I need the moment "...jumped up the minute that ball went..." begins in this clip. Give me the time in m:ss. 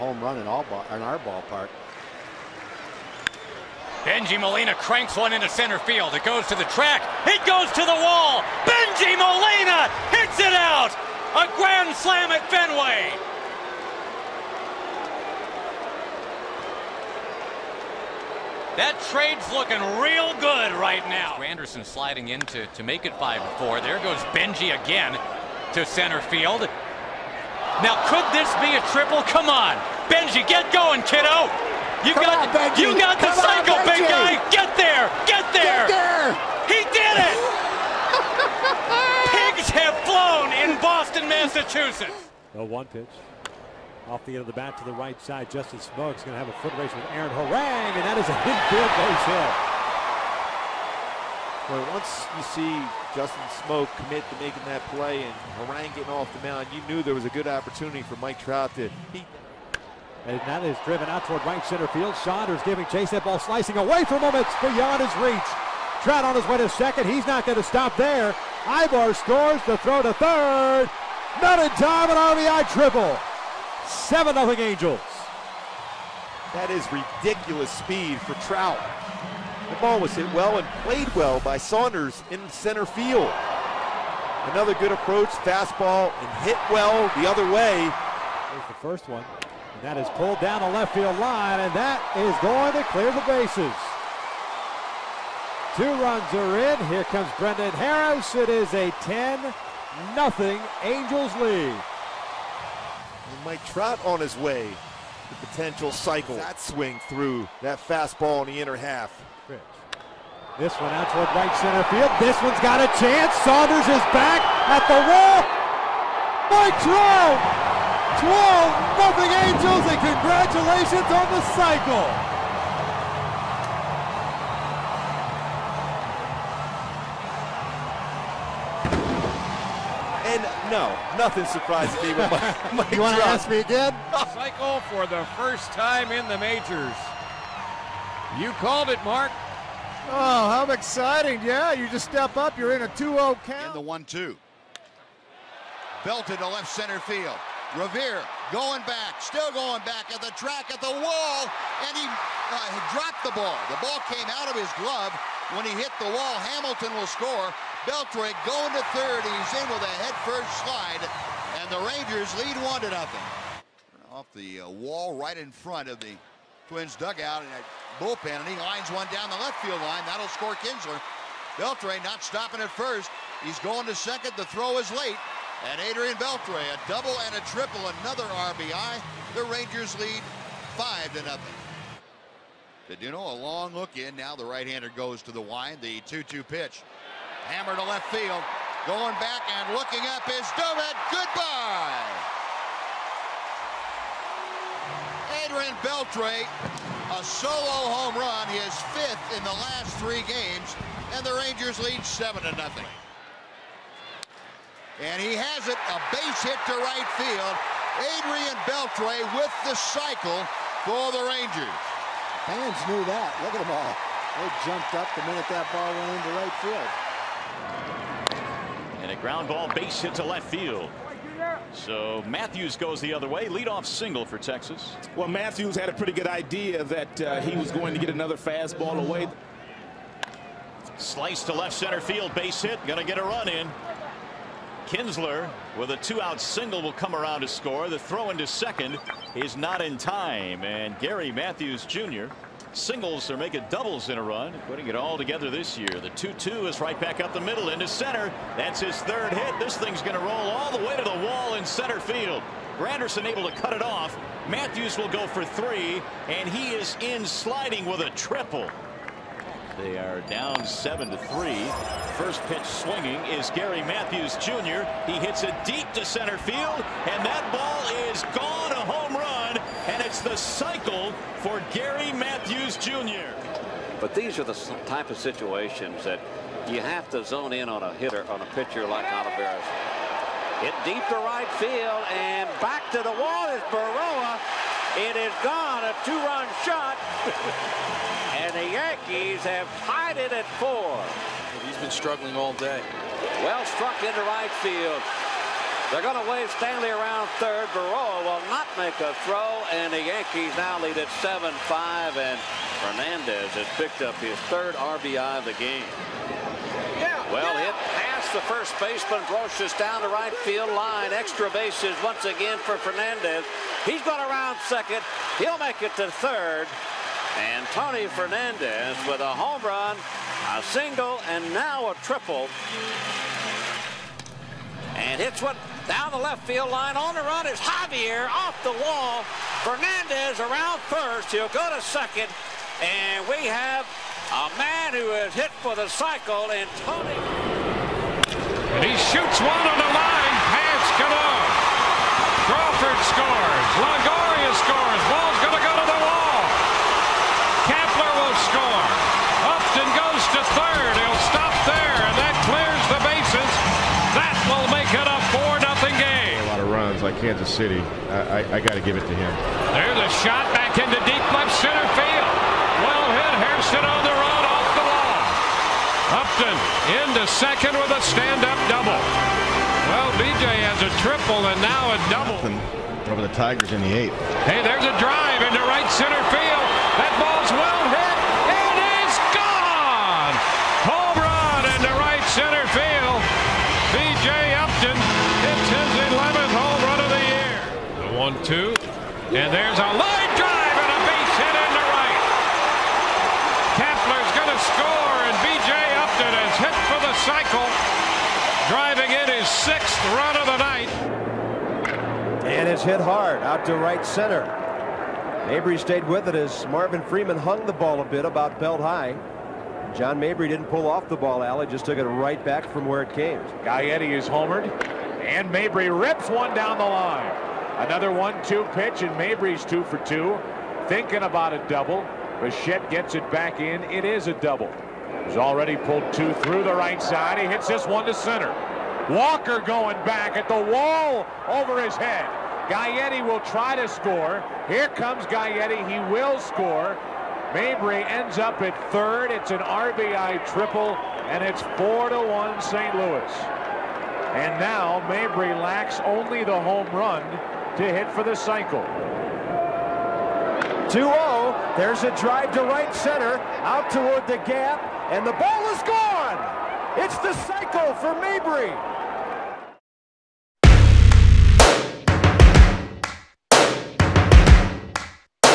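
3:34.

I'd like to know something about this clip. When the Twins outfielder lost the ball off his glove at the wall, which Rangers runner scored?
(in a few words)
Hamilton.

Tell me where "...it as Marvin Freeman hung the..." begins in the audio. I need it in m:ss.
6:46.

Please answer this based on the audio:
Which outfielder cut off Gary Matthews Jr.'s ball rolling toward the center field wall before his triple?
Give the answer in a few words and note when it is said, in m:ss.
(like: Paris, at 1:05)
Granderson, at 4:12.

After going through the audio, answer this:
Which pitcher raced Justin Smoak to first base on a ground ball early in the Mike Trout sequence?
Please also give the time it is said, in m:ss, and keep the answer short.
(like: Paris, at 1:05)
Aaron Harang, at 0:47.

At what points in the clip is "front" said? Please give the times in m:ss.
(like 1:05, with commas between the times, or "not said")
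2:45.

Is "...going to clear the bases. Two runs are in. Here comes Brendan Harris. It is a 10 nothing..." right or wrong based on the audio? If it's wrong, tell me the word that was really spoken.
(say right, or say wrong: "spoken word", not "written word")
right.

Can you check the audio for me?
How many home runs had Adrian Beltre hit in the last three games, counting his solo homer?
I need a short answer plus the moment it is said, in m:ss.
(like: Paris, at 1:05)
5th, at 3:18.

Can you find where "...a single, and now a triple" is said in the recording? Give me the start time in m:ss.
5:20.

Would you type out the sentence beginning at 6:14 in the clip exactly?
Hey, there's a drive into right center field.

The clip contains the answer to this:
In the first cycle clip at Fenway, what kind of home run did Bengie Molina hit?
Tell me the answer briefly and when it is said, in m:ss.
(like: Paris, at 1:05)
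Grand slam, at 0:11.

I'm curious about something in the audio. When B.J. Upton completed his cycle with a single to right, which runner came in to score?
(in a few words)
Kapler.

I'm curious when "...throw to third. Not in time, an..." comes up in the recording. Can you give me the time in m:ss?
1:09.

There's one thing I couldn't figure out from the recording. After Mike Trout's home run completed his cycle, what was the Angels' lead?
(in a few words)
12-0.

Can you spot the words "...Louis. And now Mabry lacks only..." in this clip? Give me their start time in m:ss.
7:22.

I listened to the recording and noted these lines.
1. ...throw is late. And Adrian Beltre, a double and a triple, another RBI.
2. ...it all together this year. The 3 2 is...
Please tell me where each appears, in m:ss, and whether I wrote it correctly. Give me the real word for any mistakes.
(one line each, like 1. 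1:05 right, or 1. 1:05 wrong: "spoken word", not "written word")
1. 2:54 right
2. 4:04 wrong: "2", not "3".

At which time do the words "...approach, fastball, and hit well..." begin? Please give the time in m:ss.
1:24.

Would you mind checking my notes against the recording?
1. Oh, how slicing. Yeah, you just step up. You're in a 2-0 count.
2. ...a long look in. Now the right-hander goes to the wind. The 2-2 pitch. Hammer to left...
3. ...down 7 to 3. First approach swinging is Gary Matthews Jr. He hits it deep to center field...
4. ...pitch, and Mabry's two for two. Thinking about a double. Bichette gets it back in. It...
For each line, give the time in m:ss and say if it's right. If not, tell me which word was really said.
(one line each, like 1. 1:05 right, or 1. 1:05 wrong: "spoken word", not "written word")
1. 2:20 wrong: "exciting", not "slicing"
2. 3:03 right
3. 4:20 wrong: "pitch", not "approach"
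4. 6:58 right.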